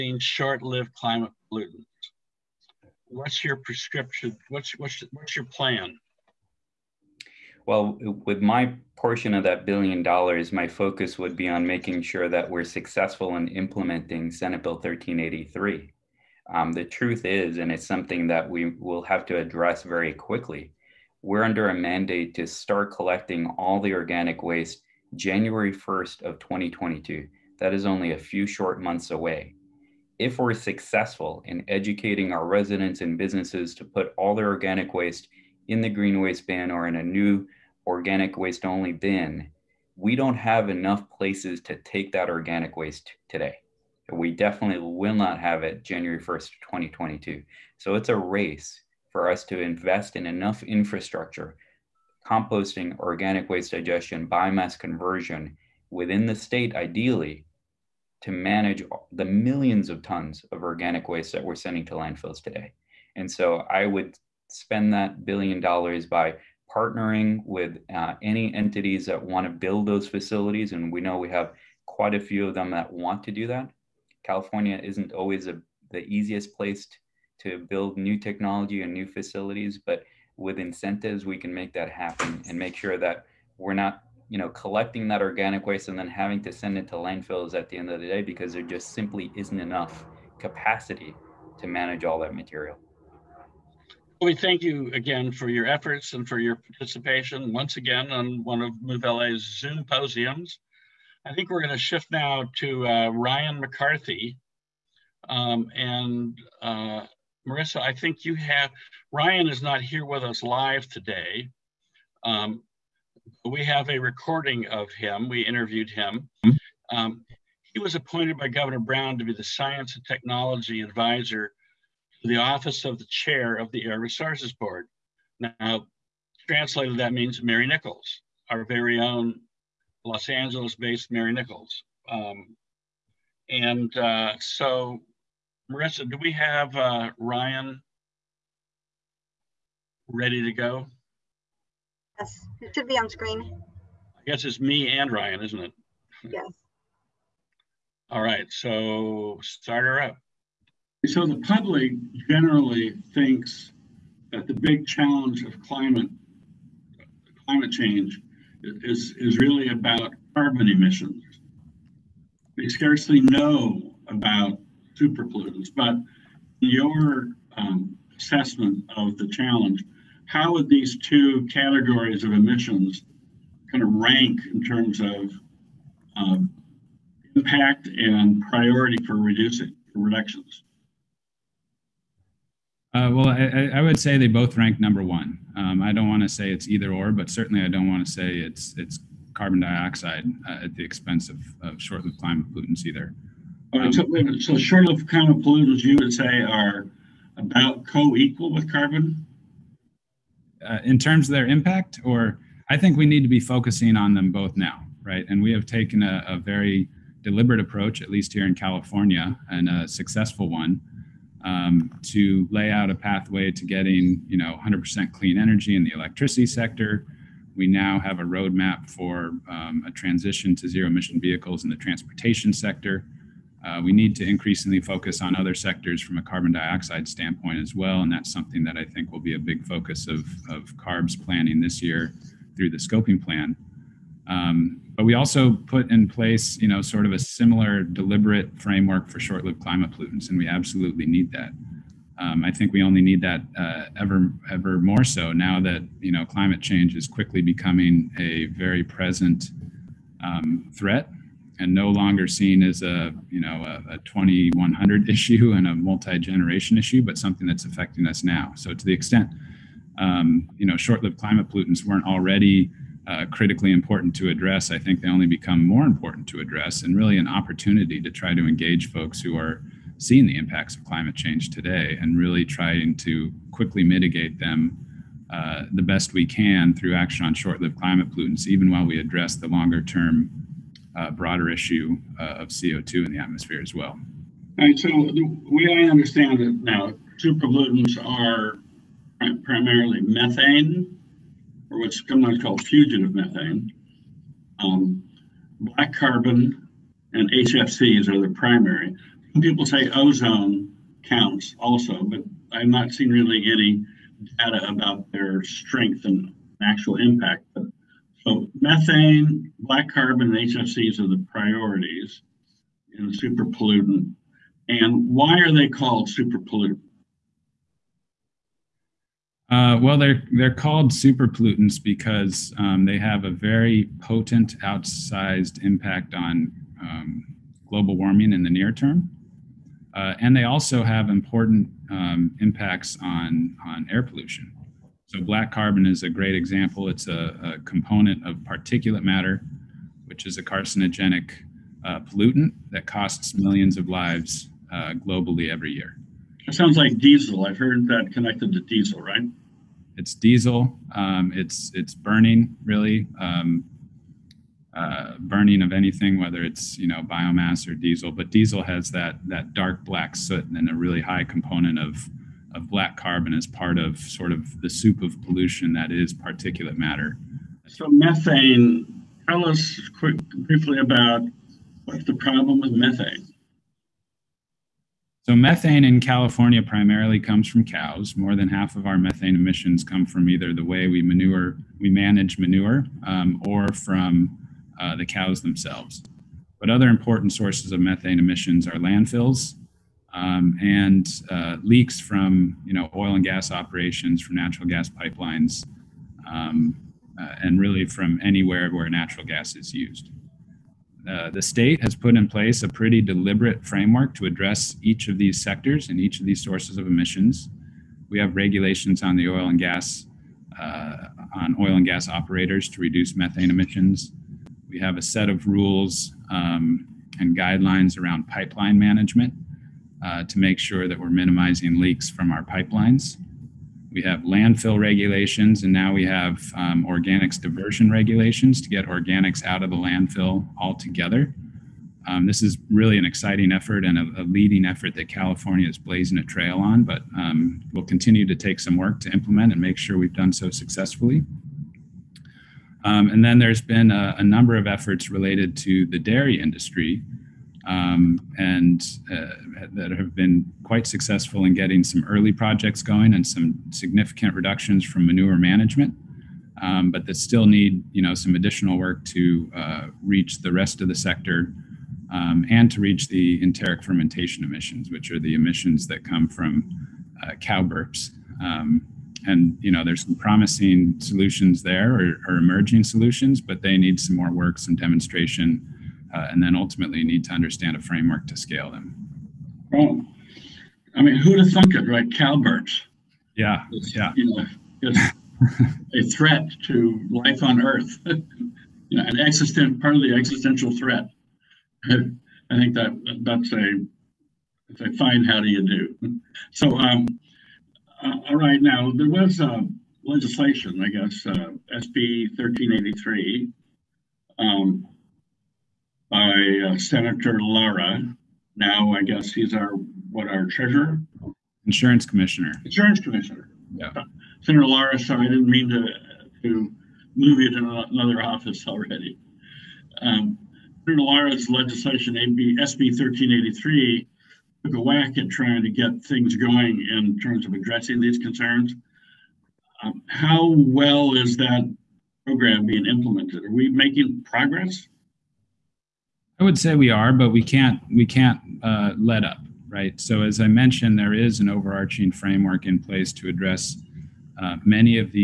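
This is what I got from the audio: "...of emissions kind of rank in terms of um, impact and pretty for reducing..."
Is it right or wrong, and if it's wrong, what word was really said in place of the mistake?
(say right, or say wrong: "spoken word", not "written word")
wrong: "priority", not "pretty".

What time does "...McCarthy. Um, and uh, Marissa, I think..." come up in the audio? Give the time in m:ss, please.
1:43.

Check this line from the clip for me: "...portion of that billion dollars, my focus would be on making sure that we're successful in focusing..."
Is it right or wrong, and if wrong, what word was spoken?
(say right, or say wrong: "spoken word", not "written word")
wrong: "implementing", not "focusing".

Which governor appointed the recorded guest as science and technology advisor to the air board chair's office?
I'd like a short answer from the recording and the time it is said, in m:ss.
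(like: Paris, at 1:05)
Governor Brown, at 1:58.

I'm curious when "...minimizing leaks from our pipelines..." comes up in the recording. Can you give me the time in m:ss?
7:01.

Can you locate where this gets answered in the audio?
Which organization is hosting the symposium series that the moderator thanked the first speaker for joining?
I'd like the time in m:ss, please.
1:38.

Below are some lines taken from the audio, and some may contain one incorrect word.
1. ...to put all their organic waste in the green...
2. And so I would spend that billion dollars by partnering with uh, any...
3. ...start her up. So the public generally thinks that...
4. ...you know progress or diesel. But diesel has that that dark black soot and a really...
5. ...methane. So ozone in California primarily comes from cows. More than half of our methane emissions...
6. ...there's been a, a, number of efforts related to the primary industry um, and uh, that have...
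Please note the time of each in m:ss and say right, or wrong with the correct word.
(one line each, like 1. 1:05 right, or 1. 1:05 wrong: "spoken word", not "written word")
1. 0:33 right
2. 1:03 right
3. 2:29 right
4. 5:56 wrong: "biomass", not "progress"
5. 6:12 wrong: "methane", not "ozone"
6. 7:23 wrong: "dairy", not "primary".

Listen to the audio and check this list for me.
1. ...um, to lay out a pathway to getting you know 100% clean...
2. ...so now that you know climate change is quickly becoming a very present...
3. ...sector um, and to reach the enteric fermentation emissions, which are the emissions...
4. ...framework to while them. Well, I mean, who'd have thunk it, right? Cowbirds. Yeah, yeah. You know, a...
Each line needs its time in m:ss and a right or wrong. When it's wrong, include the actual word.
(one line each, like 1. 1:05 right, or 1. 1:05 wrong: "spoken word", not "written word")
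1. 3:31 right
2. 4:05 right
3. 7:40 right
4. 7:57 wrong: "scale", not "while".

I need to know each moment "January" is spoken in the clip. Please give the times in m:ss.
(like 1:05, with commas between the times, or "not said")
0:25, 0:45.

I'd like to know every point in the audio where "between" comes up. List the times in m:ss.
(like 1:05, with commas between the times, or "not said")
not said.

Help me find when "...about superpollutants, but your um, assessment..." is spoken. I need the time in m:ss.
2:44.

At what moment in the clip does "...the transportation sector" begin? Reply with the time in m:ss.
3:41.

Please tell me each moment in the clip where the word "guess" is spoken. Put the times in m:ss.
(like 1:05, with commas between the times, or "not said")
2:24, 8:20, 8:29.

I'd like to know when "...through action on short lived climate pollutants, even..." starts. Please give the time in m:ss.
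4:36.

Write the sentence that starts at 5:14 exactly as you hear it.
And why are they called super pollutant?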